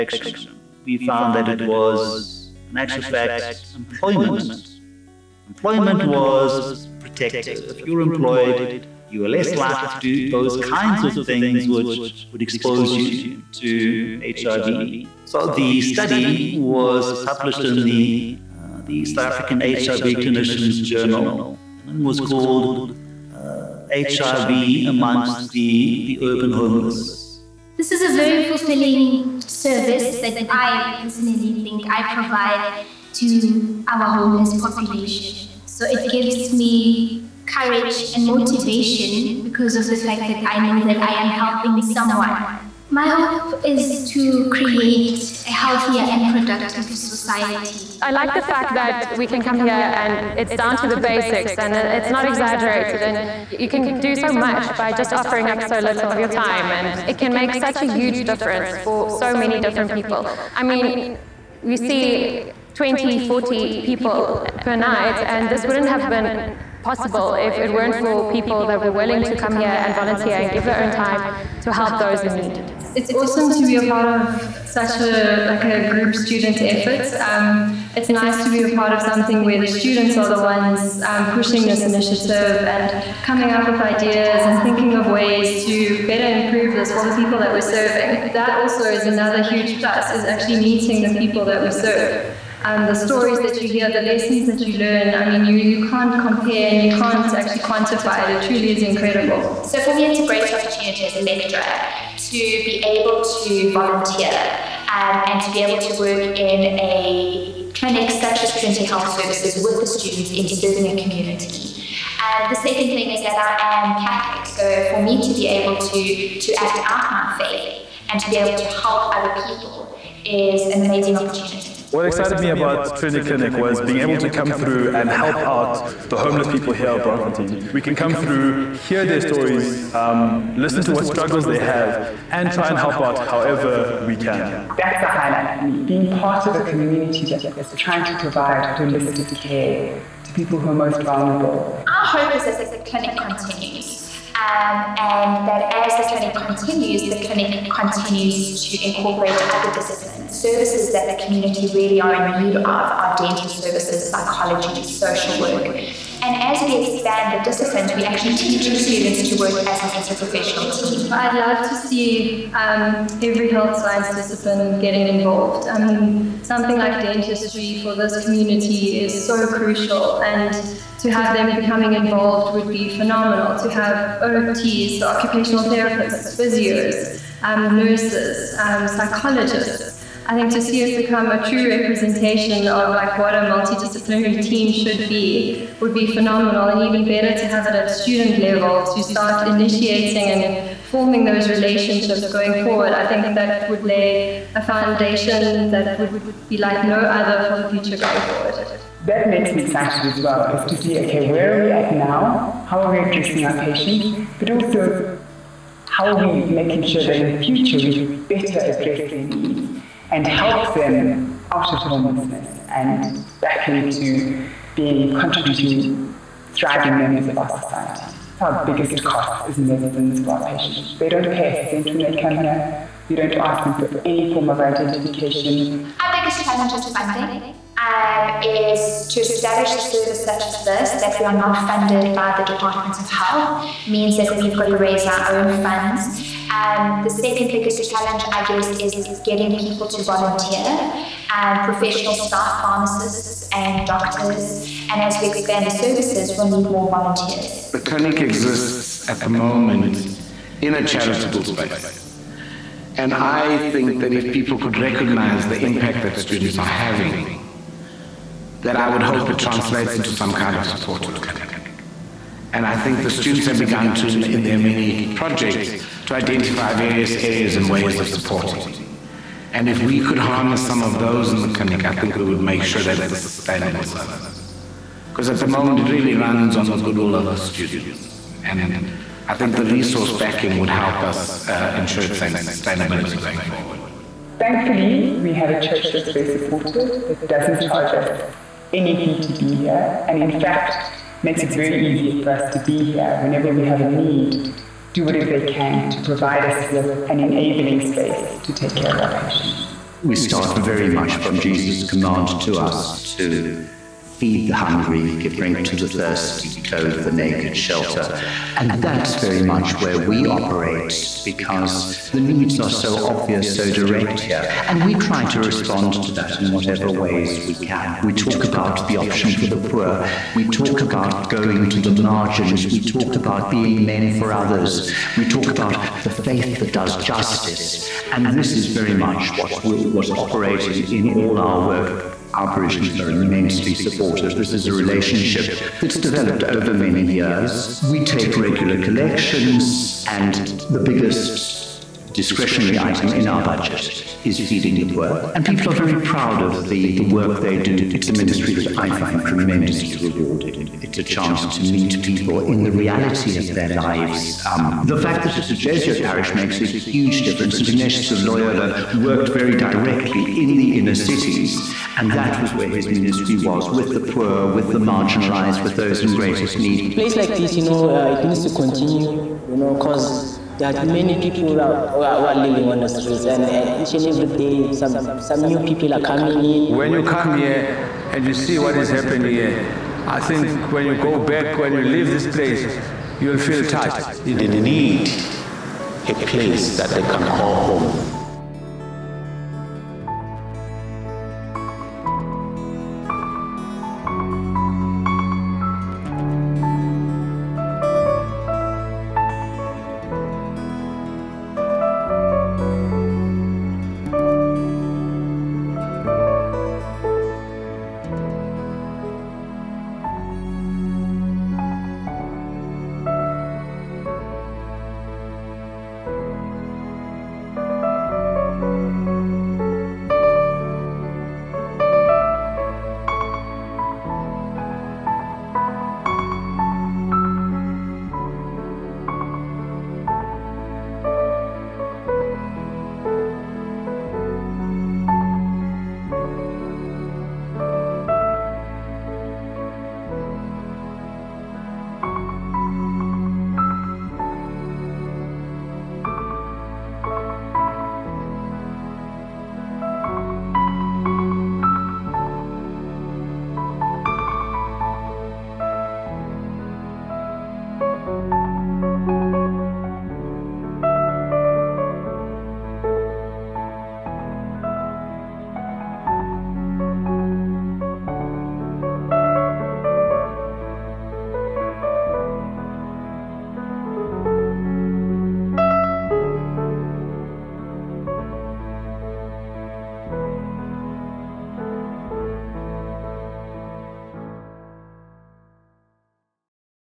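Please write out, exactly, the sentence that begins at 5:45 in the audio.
And people are very proud of the, the work they do.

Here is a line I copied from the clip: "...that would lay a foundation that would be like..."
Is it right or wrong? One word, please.
right.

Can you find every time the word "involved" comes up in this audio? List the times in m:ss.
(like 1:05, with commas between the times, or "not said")
2:45, 2:51.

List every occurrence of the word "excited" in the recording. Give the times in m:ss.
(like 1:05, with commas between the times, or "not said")
2:02, 3:19.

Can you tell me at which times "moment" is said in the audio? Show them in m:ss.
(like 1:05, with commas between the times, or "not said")
4:09, 4:35.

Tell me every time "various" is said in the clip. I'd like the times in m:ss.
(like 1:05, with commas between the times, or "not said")
4:26.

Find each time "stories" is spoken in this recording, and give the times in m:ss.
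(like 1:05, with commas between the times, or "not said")
1:32, 2:09.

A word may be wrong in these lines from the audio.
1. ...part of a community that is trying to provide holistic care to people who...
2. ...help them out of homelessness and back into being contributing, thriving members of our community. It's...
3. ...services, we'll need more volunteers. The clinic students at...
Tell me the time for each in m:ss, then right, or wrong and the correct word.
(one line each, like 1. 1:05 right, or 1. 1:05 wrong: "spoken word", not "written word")
1. 2:16 right
2. 3:30 wrong: "society", not "community"
3. 4:05 wrong: "exists", not "students".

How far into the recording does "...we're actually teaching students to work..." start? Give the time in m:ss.
2:37.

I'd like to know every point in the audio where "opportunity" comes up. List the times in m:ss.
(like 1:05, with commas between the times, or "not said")
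1:40, 2:01.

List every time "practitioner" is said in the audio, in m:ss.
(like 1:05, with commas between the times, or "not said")
not said.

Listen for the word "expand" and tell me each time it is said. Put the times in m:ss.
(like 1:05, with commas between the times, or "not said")
2:36, 4:05.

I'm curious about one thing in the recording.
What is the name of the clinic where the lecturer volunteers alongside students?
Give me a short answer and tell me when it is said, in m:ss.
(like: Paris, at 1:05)
Trinity Health Services, at 1:48.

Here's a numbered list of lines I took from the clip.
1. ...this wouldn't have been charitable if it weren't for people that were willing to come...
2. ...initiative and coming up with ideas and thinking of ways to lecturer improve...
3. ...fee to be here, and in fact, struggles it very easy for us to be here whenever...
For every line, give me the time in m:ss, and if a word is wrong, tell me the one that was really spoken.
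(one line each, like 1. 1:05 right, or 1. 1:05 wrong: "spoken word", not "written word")
1. 1:05 wrong: "possible", not "charitable"
2. 1:21 wrong: "better", not "lecturer"
3. 4:48 wrong: "makes", not "struggles".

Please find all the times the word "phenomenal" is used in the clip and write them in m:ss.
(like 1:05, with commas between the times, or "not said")
2:52, 3:06.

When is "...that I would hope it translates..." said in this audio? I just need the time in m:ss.
4:18.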